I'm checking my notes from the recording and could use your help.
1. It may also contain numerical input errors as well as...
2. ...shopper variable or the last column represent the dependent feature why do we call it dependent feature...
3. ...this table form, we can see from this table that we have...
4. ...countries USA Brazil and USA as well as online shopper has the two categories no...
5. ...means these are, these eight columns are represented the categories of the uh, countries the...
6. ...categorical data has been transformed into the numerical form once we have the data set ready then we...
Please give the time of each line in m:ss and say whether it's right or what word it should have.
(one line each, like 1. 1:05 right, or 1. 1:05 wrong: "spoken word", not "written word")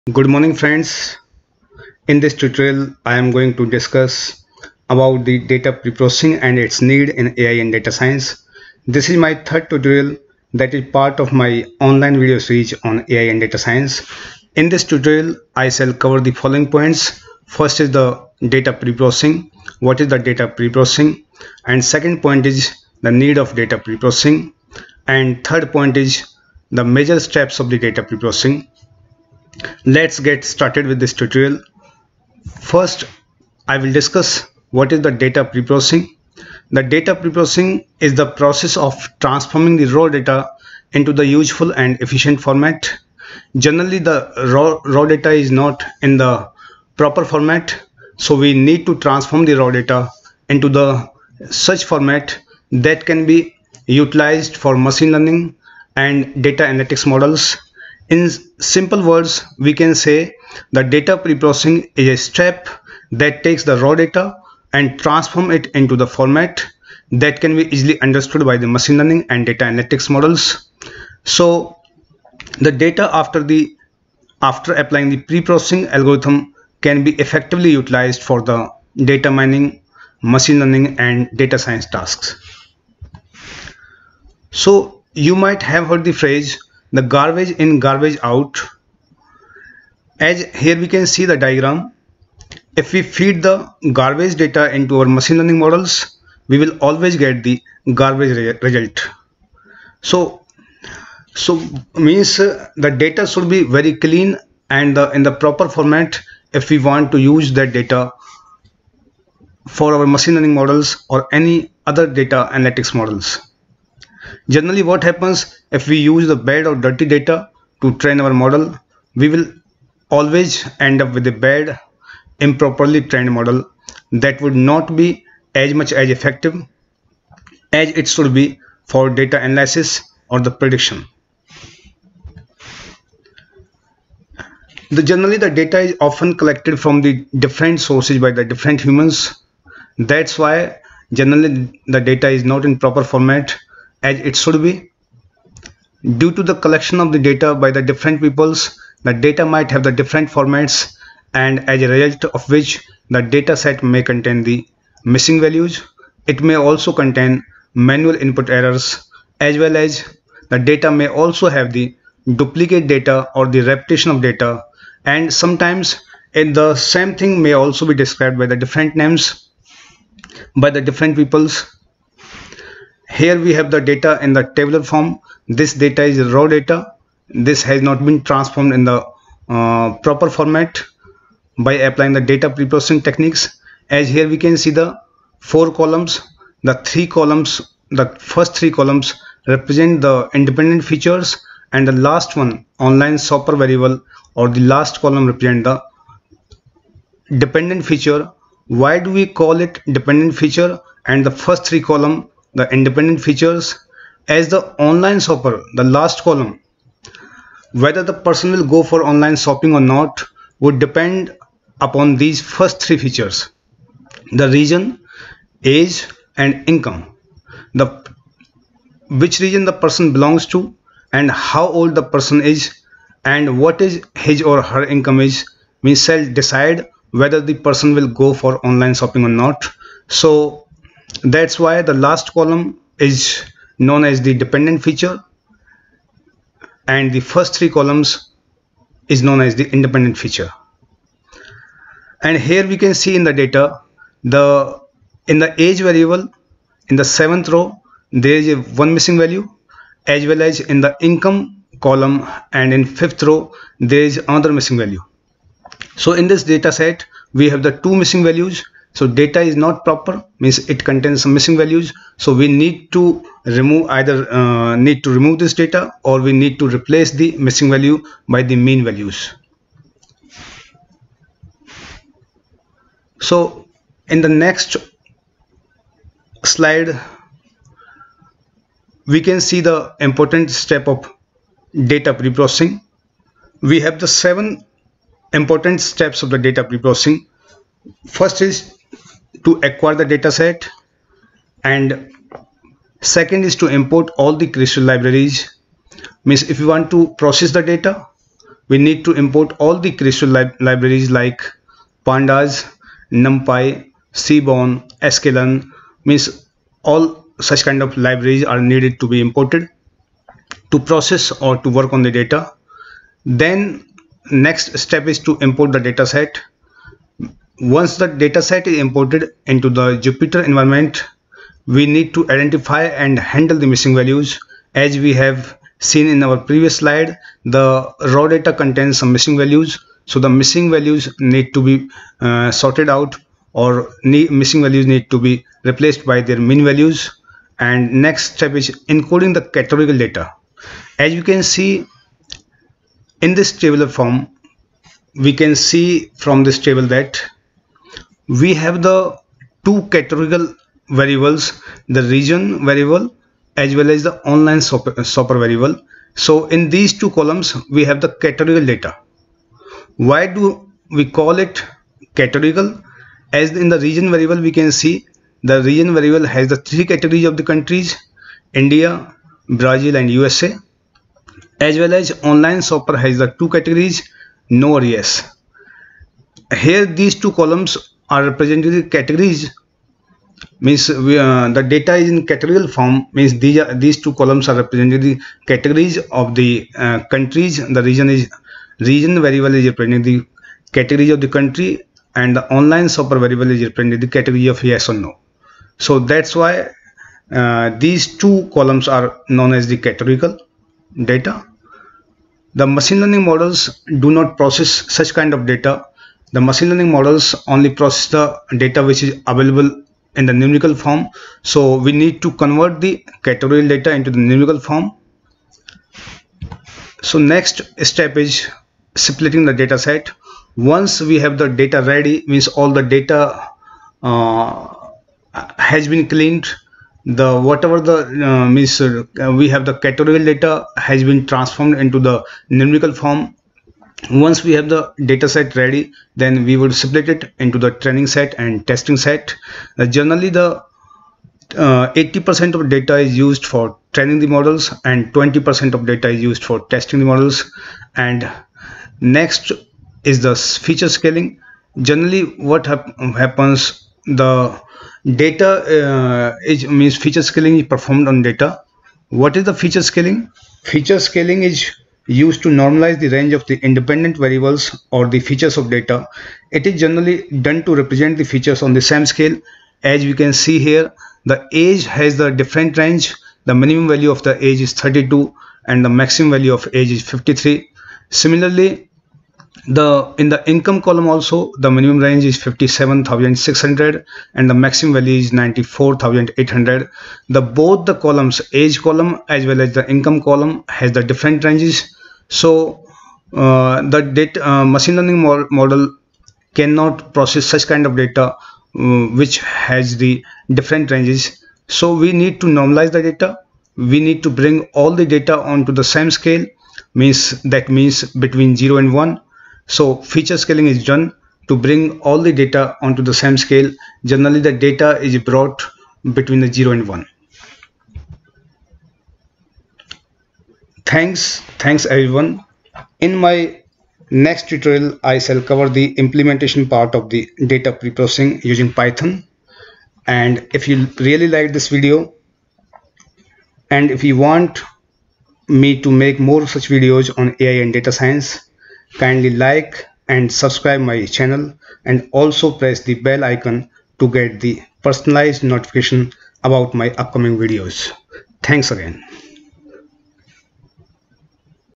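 1. 2:36 wrong: "manual", not "numerical"
2. 3:13 right
3. 5:43 right
4. 6:07 wrong: "India", not "USA"
5. 6:23 wrong: "two", not "eight"
6. 7:09 right.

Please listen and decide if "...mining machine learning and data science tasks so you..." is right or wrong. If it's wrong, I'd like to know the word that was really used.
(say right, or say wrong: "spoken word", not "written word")
right.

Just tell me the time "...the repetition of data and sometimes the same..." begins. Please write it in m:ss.
2:43.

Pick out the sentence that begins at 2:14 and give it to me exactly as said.
The, generally the data is often collected from the different sources by the different humans.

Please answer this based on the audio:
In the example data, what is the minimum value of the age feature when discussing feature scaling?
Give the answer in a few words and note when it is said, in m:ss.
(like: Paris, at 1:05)
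32, at 7:54.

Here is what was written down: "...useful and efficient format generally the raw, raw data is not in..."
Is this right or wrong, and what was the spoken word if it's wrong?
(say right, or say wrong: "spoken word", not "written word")
right.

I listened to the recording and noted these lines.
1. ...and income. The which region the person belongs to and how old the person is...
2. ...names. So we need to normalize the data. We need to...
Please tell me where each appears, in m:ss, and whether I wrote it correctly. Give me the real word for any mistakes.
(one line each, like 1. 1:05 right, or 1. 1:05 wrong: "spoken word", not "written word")
1. 3:36 right
2. 8:20 wrong: "ranges", not "names".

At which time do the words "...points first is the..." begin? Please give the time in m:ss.
0:16.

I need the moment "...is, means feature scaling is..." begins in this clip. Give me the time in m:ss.
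7:36.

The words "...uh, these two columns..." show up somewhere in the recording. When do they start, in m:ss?
6:37.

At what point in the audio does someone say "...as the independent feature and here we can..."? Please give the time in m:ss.
3:59.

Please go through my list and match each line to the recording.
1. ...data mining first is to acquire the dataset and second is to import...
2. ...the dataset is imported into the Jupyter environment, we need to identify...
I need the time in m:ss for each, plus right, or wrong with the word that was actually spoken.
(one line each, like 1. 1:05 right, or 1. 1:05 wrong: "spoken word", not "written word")
1. 4:46 wrong: "preprocessing", not "mining"
2. 5:17 right.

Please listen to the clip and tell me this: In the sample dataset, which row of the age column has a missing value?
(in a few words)
seventh.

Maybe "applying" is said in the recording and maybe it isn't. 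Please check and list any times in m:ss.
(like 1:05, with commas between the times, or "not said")
1:14, 3:01.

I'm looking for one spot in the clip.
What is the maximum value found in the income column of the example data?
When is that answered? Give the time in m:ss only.
8:05.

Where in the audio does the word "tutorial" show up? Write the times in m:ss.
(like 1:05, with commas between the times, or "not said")
0:02, 0:09, 0:14, 0:31, 8:44.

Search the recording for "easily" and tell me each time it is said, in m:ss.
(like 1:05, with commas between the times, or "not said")
1:07.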